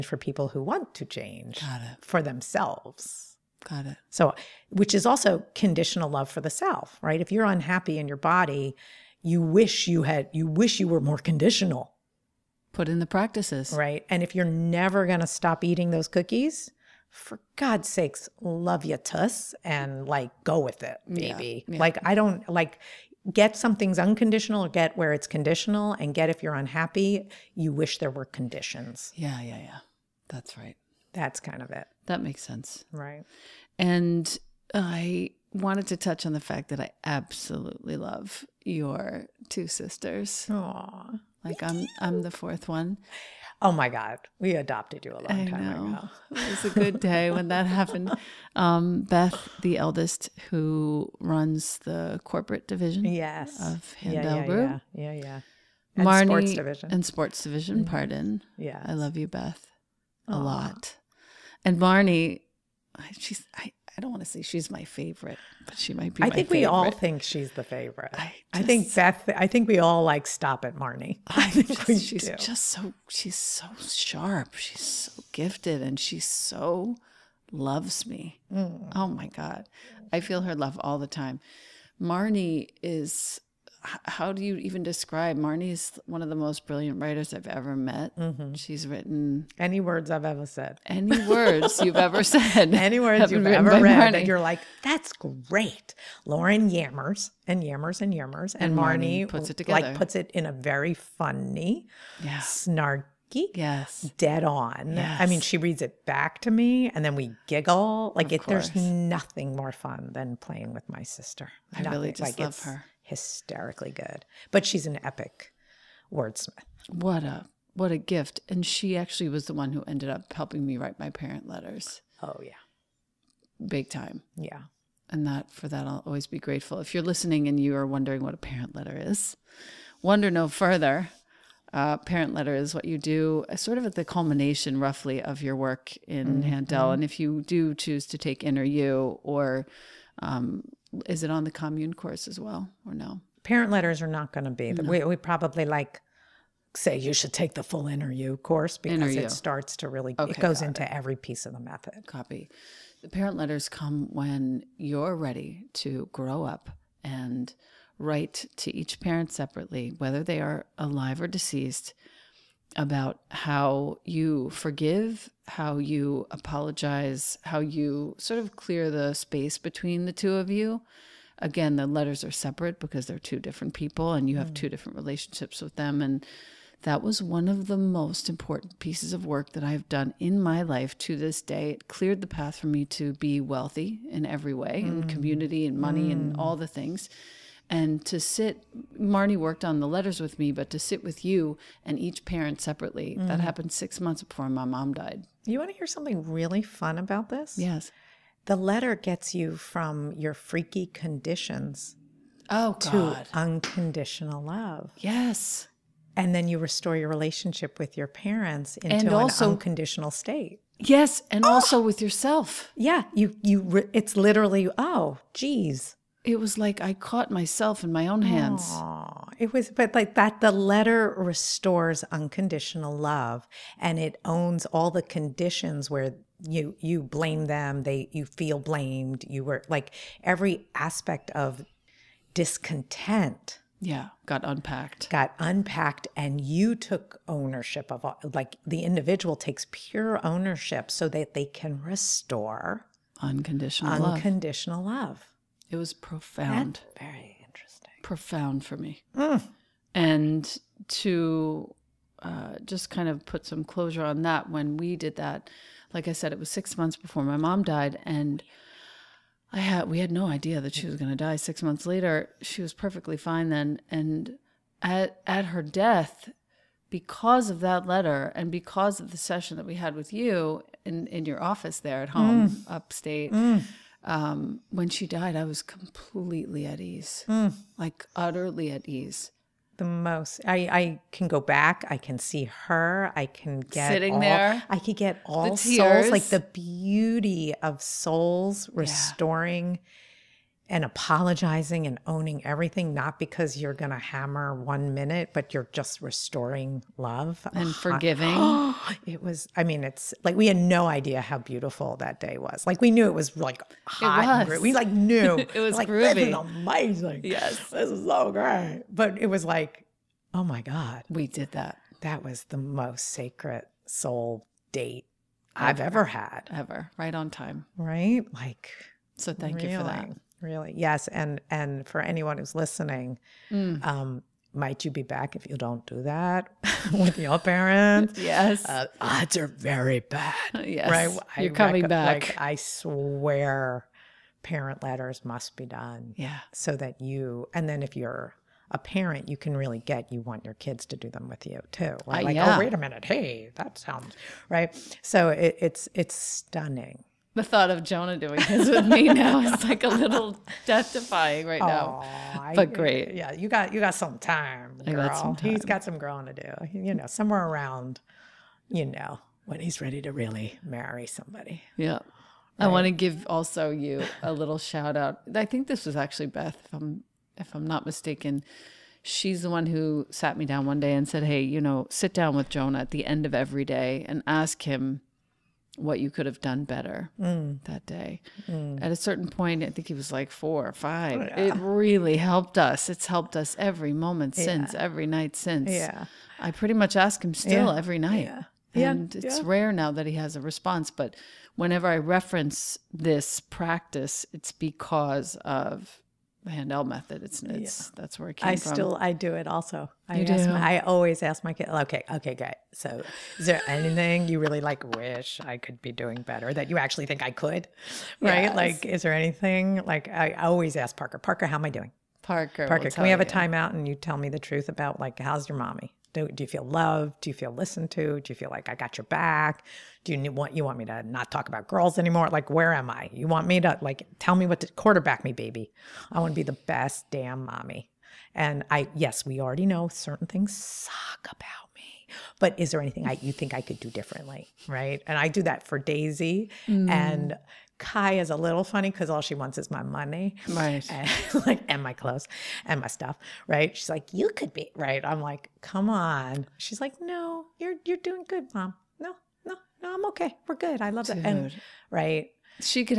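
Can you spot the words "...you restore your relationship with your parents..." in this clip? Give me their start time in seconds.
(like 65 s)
206 s.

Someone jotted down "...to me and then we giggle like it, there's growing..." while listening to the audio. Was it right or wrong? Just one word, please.
wrong.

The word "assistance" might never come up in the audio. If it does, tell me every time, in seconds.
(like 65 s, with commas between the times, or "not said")
not said.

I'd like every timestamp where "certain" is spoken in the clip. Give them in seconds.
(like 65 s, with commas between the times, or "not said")
378 s, 429 s.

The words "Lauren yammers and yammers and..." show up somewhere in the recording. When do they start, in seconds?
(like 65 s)
96 s.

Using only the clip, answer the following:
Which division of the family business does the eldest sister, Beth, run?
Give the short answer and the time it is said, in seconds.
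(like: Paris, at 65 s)
Corporate division, at 52 s.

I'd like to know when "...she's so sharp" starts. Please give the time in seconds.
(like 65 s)
73 s.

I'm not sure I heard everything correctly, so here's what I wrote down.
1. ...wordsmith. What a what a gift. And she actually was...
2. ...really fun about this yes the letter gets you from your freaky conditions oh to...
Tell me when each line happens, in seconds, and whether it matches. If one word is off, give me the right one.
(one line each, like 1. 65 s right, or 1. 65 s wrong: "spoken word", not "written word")
1. 116 s right
2. 196 s right.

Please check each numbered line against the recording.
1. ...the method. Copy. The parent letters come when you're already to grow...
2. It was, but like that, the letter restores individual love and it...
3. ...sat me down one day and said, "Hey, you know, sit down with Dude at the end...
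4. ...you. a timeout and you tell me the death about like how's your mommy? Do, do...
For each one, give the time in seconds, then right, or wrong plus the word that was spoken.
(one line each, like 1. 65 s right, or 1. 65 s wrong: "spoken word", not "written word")
1. 151 s wrong: "ready", not "already"
2. 219 s wrong: "unconditional", not "individual"
3. 370 s wrong: "Jonah", not "Dude"
4. 413 s wrong: "truth", not "death".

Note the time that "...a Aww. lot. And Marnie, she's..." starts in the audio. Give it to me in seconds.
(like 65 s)
60 s.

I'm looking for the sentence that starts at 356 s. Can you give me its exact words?
You know, somewhere around, you know, when he's ready to really marry somebody.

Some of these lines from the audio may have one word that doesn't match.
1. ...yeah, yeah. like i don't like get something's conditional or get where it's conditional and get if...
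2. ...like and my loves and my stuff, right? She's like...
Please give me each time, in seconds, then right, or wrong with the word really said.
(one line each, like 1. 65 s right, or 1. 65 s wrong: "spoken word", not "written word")
1. 21 s wrong: "unconditional", not "conditional"
2. 441 s wrong: "clothes", not "loves".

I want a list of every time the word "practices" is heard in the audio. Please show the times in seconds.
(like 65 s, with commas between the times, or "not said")
13 s, 393 s.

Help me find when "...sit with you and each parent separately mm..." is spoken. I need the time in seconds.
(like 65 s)
190 s.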